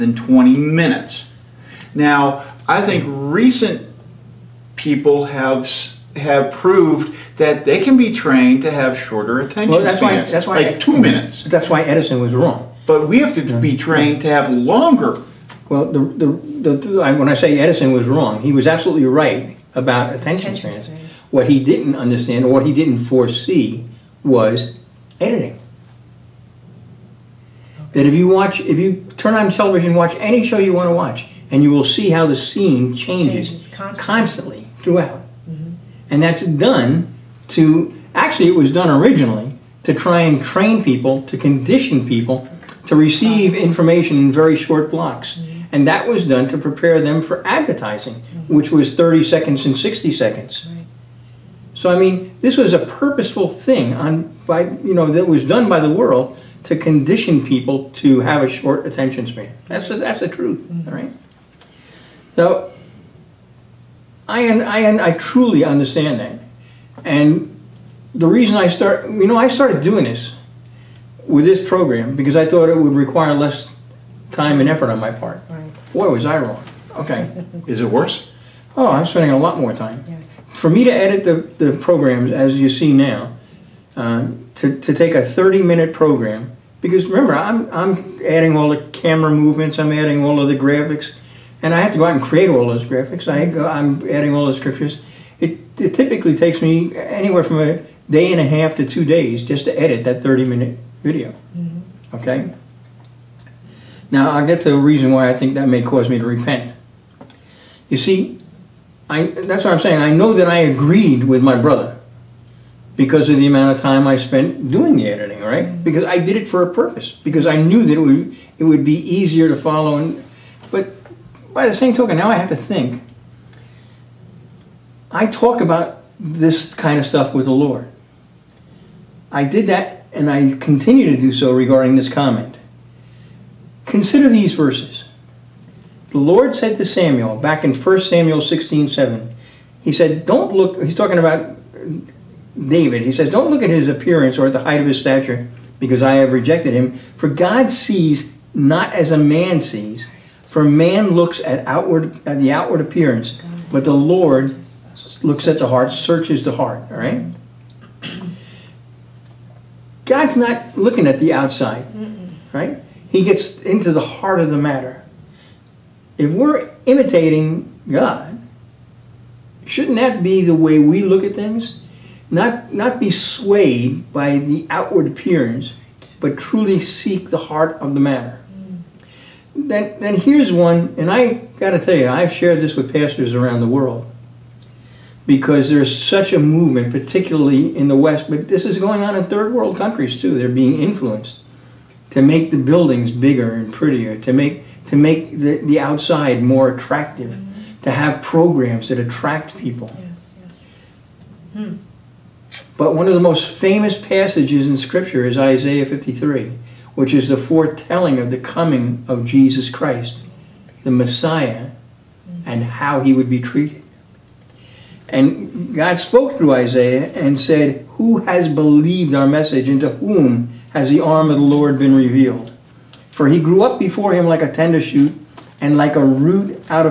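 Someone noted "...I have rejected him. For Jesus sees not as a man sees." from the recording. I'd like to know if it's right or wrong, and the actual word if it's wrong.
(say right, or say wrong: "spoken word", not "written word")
wrong: "God", not "Jesus".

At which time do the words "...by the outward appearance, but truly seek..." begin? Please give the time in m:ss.
2:54.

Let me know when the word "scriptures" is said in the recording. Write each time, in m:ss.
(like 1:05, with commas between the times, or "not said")
1:34, 3:24.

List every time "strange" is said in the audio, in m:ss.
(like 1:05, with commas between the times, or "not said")
not said.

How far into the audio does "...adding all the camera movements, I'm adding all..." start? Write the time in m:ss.
1:28.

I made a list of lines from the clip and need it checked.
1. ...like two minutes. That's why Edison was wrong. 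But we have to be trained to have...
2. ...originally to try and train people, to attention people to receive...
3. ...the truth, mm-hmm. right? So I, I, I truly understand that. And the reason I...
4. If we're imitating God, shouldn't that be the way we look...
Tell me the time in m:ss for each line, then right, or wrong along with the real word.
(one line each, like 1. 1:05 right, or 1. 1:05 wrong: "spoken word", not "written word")
1. 0:10 right
2. 0:38 wrong: "condition", not "attention"
3. 1:00 right
4. 2:46 right.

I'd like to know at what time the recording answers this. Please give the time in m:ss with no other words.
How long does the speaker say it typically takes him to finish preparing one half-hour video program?
1:37.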